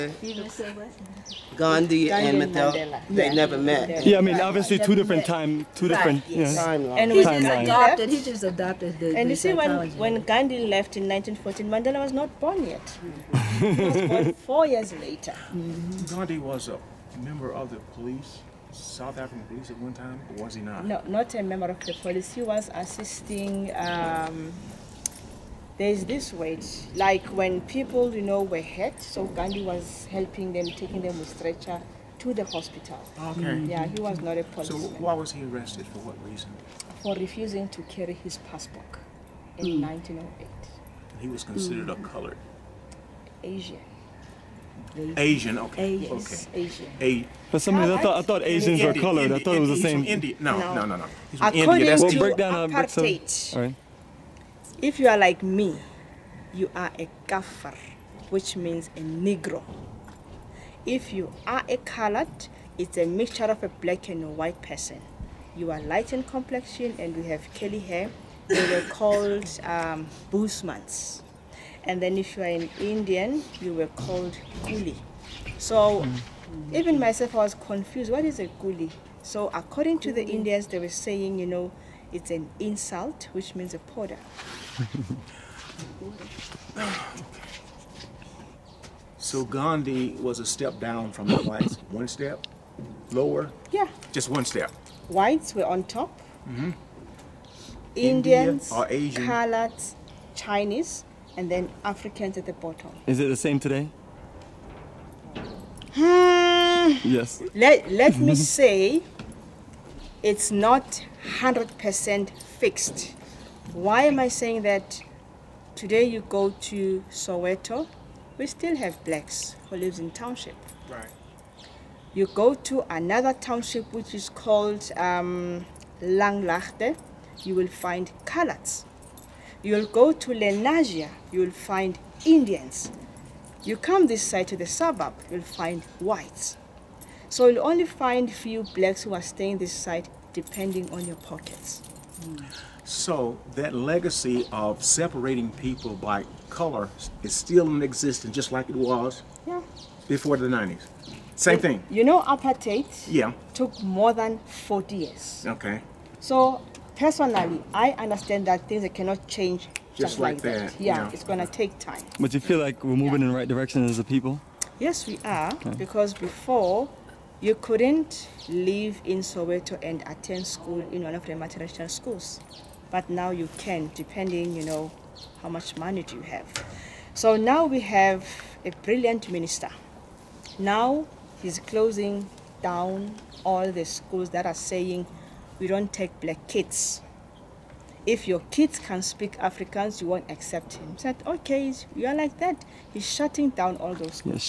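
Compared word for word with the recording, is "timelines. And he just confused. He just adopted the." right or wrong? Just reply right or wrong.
wrong.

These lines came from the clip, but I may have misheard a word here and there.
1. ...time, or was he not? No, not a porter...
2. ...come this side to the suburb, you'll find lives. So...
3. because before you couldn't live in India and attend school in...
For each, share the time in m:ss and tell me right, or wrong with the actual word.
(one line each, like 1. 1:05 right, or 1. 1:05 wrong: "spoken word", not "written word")
1. 0:19 wrong: "member", not "porter"
2. 2:13 wrong: "whites", not "lives"
3. 2:45 wrong: "Soweto", not "India".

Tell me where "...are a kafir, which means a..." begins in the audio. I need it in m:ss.
0:56.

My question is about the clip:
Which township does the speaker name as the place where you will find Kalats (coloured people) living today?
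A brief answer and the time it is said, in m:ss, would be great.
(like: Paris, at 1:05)
Langlaagte, at 2:05.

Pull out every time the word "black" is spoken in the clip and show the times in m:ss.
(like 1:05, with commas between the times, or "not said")
1:03, 1:59, 2:18, 3:06.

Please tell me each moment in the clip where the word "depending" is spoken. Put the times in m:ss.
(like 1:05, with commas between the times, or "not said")
2:20, 2:53.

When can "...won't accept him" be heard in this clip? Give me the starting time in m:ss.
3:10.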